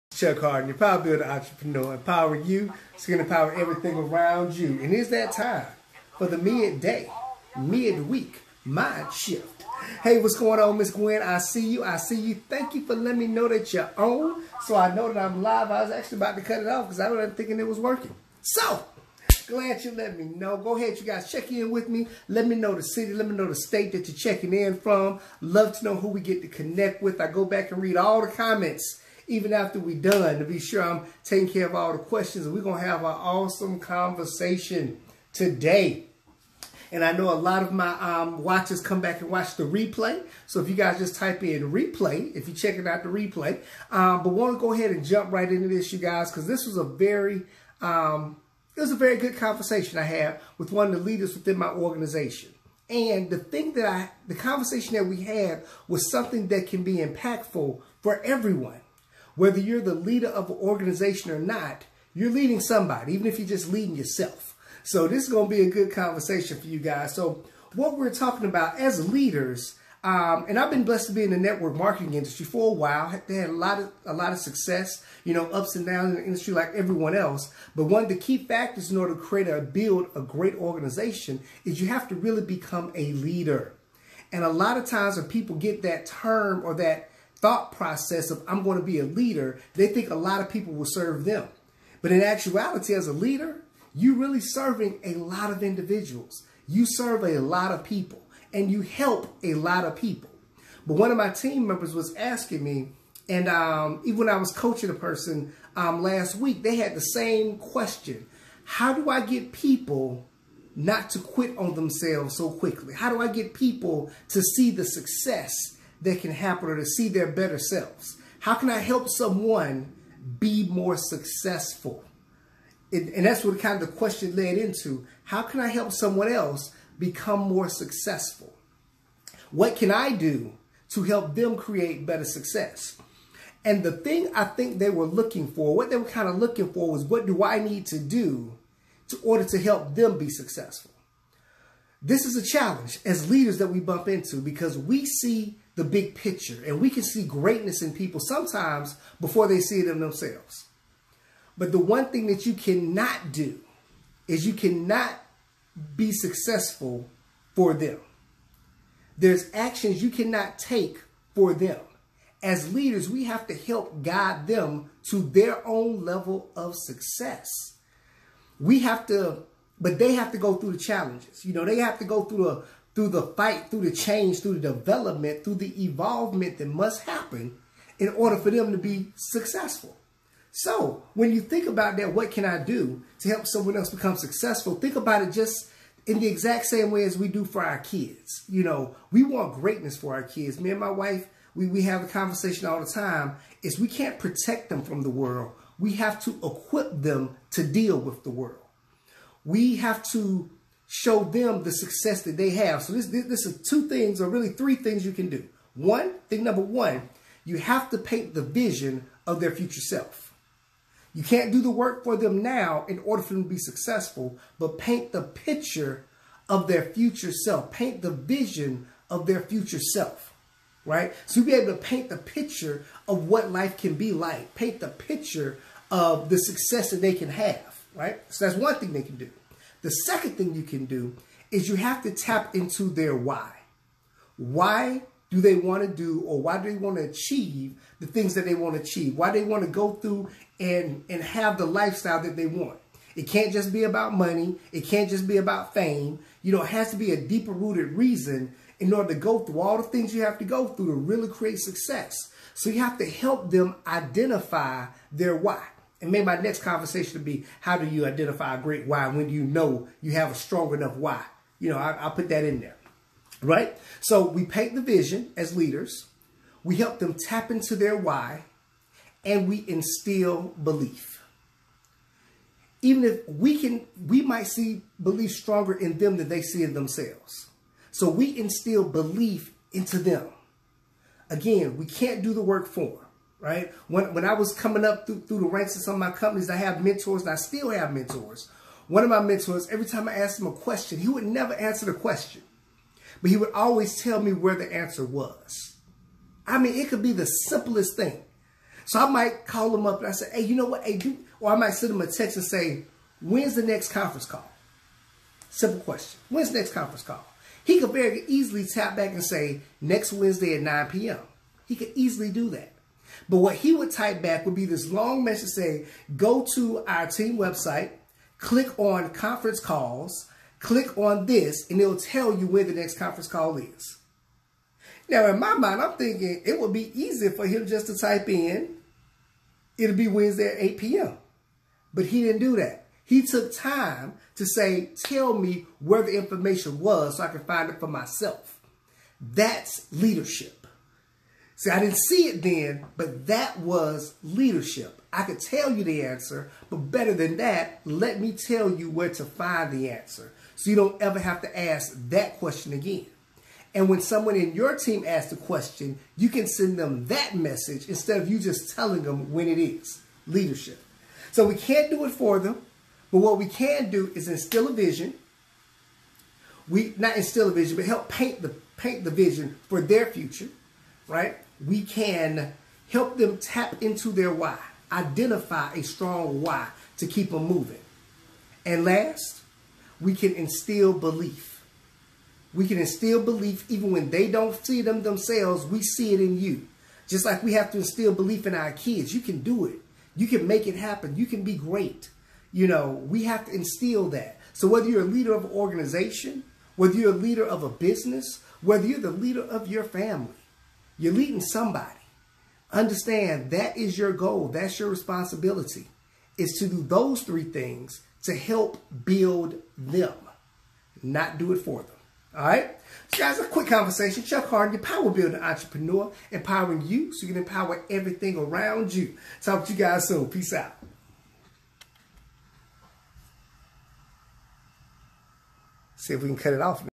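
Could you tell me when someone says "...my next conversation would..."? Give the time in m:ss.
4:16.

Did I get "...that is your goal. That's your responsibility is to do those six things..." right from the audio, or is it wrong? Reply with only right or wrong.
wrong.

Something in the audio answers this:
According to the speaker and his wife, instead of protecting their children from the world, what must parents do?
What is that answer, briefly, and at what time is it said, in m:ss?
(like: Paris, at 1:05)
Equip them, at 3:16.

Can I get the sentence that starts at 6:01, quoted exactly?
So we can't do it for them, but what we can do is instill a vision.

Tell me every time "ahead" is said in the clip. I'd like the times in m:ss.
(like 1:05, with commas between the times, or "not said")
0:20, 0:44.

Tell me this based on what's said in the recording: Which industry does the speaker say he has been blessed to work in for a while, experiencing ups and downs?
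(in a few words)
Network marketing.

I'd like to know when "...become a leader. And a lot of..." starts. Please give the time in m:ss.
1:22.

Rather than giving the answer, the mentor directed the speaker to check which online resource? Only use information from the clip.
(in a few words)
Team website.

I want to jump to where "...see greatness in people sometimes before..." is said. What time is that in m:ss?
2:27.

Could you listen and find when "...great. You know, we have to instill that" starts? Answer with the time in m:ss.
6:31.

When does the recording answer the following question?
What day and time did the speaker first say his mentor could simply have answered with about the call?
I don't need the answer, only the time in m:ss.
5:09.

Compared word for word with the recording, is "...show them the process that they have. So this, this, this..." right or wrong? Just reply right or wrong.
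wrong.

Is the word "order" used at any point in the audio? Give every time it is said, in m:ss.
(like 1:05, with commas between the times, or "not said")
1:18, 2:19, 2:58, 3:33, 4:08.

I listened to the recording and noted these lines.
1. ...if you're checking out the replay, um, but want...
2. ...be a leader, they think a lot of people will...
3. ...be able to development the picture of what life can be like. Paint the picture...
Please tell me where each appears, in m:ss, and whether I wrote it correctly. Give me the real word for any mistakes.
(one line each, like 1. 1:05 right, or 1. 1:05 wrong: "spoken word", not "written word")
1. 0:42 right
2. 1:28 right
3. 3:41 wrong: "paint", not "development".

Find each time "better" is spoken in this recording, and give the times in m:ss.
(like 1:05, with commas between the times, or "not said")
1:57, 2:12, 5:46.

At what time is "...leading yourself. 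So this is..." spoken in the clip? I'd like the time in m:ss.
1:03.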